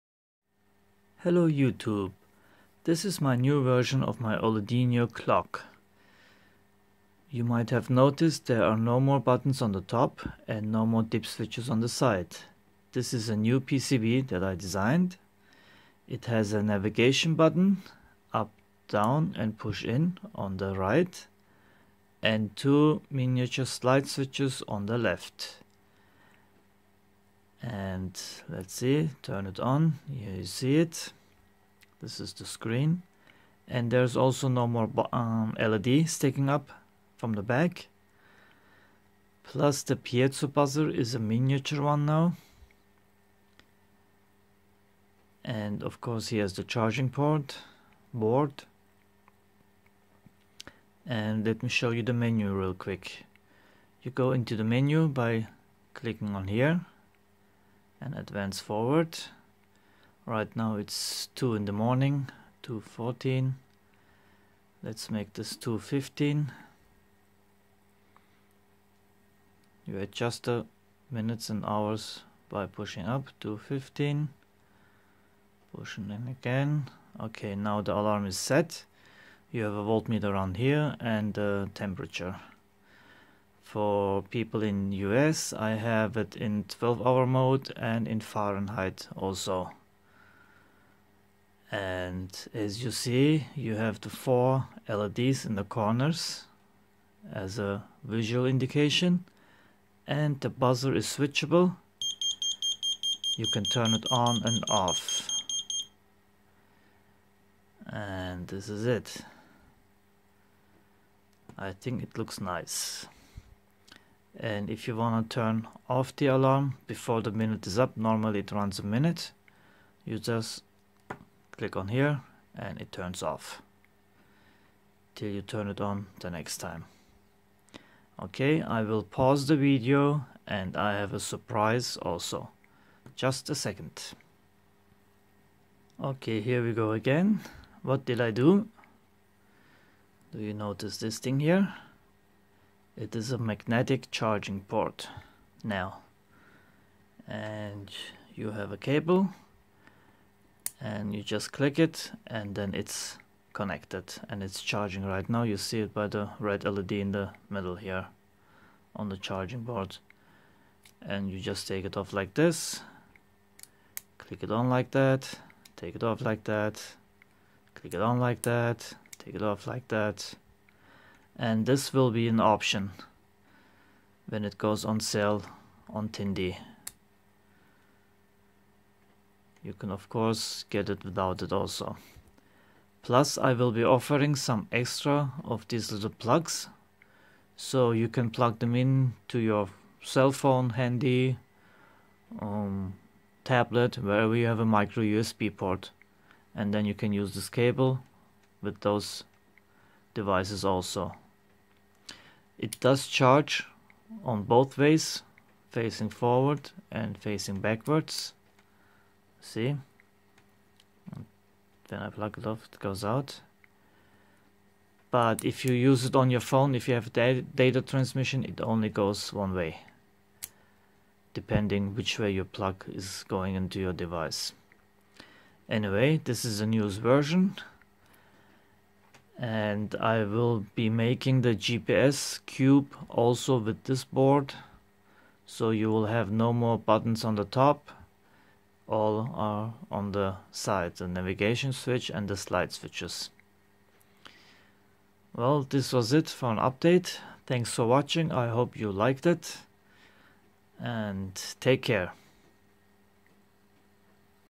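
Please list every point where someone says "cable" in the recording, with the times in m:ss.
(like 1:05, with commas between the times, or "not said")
2:28, 3:17.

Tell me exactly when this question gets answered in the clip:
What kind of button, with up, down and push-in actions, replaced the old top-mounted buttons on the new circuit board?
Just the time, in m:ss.
0:16.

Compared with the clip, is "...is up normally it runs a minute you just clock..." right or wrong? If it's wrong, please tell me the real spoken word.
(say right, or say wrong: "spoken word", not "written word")
wrong: "click", not "clock".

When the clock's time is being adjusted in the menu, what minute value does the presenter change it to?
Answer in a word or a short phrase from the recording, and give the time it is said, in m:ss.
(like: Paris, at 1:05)
2.15, at 1:05.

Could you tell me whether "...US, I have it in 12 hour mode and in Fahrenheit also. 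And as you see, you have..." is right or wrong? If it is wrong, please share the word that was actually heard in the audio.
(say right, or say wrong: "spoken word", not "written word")
right.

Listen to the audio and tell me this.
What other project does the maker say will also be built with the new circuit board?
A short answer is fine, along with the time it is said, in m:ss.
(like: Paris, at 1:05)
GPS cube, at 3:51.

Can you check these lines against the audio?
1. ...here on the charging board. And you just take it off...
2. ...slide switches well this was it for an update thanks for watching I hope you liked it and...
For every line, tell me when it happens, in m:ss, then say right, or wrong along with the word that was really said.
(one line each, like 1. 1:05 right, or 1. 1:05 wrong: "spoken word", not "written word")
1. 2:37 right
2. 4:02 right.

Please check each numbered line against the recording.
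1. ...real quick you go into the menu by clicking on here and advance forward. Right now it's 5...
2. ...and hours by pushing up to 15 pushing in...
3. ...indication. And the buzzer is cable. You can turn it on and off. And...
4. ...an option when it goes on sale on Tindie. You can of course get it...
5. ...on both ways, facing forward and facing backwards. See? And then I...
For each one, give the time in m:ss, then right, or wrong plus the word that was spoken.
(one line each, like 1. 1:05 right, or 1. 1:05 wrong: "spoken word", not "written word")
1. 0:52 wrong: "2", not "5"
2. 1:11 right
3. 1:38 wrong: "switchable", not "cable"
4. 2:52 right
5. 3:24 right.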